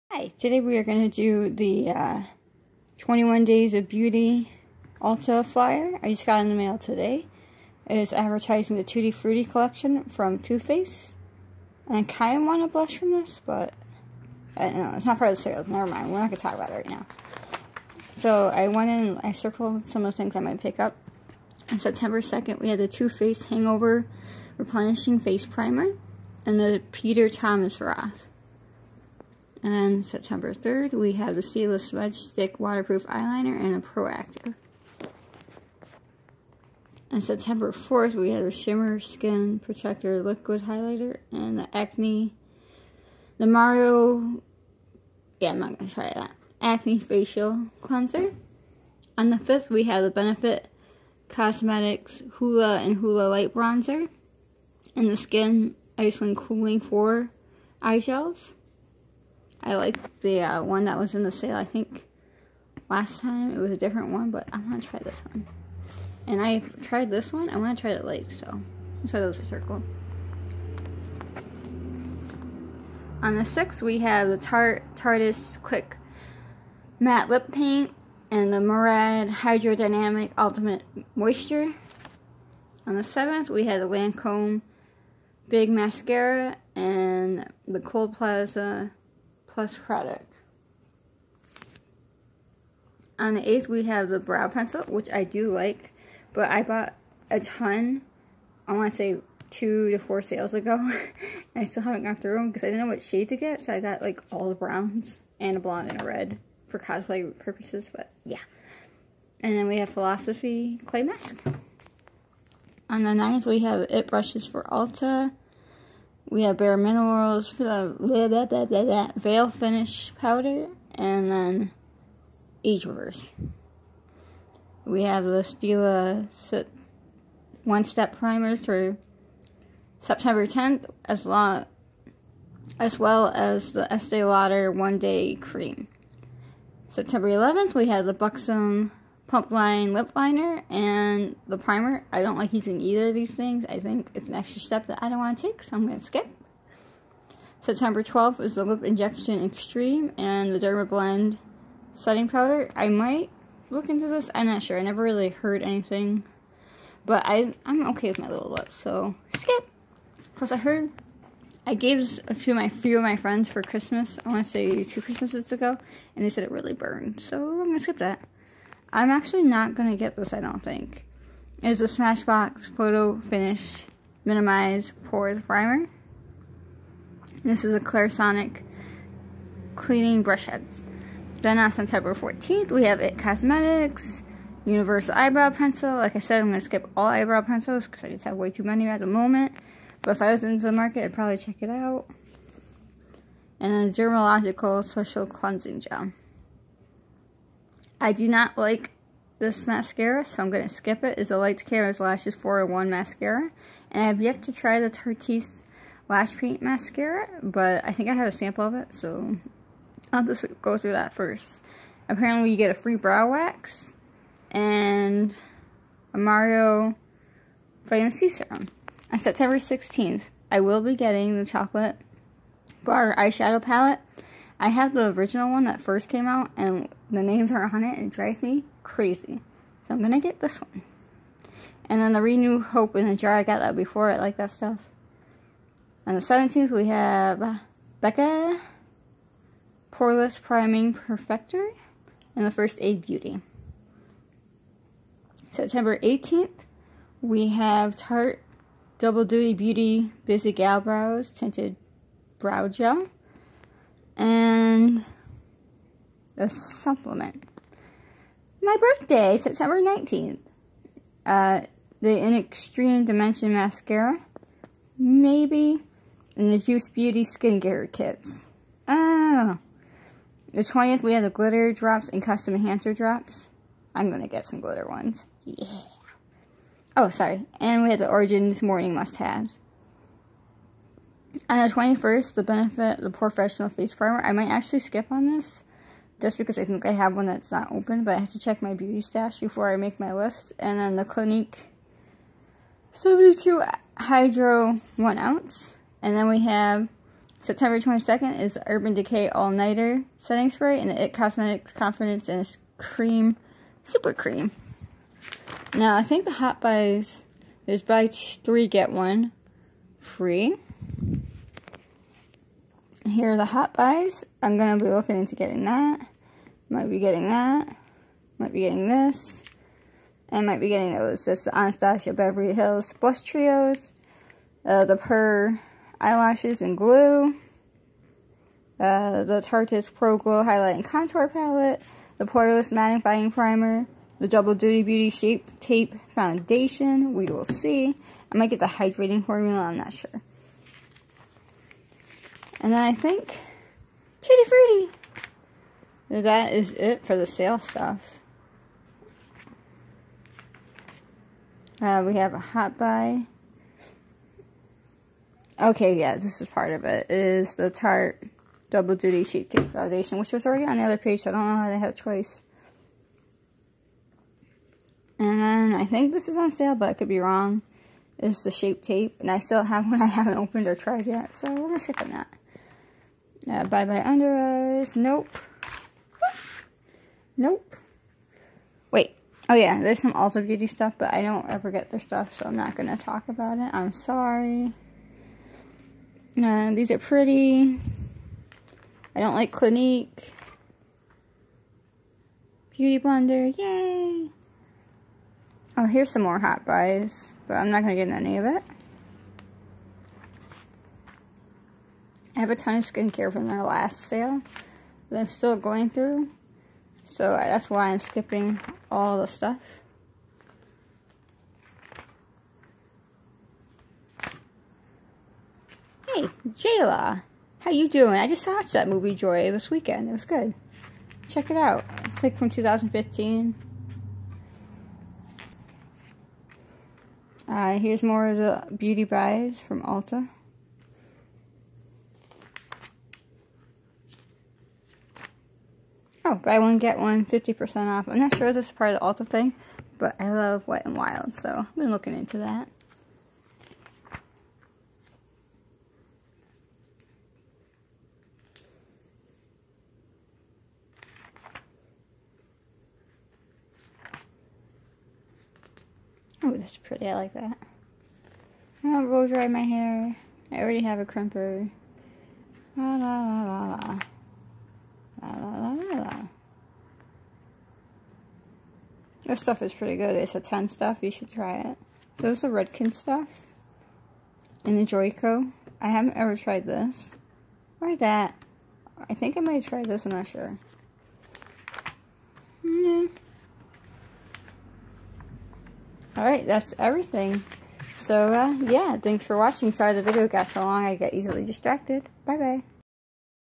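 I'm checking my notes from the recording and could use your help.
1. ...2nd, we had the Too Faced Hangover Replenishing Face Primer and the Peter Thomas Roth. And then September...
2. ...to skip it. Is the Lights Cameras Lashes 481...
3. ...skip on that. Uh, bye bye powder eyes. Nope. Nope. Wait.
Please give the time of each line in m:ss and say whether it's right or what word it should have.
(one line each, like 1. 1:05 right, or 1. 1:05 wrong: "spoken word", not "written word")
1. 0:22 right
2. 3:20 wrong: "401", not "481"
3. 6:11 wrong: "under", not "powder".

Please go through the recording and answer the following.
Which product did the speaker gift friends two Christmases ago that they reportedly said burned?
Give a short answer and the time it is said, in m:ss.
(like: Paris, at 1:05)
Lip Injection Extreme, at 2:28.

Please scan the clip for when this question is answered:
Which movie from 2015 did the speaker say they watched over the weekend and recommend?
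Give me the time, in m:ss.
6:59.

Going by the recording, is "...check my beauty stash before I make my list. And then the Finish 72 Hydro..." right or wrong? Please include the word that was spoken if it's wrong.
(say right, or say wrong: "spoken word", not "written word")
wrong: "Clinique", not "Finish".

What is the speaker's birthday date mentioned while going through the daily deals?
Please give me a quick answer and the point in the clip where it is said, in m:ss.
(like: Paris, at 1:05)
September 19th, at 4:19.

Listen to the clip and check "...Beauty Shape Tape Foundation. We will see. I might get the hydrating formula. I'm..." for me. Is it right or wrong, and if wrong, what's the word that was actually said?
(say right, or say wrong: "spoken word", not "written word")
right.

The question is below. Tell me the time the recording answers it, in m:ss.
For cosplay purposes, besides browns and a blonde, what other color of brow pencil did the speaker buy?
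1:46.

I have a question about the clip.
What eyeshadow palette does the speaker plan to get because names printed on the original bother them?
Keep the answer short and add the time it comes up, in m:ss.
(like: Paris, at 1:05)
chocolate bar, at 3:41.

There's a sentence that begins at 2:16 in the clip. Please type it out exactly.
September 11th, we have the Buxom pump line lip liner and the primer.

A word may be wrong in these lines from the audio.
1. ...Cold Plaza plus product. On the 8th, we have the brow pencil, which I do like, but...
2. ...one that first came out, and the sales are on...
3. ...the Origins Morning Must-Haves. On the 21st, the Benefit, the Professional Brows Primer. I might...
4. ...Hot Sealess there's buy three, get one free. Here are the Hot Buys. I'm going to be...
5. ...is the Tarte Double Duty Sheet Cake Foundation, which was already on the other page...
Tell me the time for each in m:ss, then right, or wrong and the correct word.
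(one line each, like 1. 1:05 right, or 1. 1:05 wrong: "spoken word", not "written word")
1. 1:27 right
2. 3:45 wrong: "names", not "sales"
3. 4:37 wrong: "Face", not "Brows"
4. 5:06 wrong: "Buys", not "Sealess"
5. 5:57 right.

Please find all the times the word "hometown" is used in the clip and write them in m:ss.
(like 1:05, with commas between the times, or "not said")
not said.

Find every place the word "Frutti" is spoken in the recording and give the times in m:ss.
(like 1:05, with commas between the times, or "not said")
0:09, 5:44.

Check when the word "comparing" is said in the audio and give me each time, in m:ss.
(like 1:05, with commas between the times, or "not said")
not said.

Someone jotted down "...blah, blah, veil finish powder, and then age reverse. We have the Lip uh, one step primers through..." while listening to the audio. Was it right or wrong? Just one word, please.
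wrong.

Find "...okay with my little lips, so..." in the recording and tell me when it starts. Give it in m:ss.
2:37.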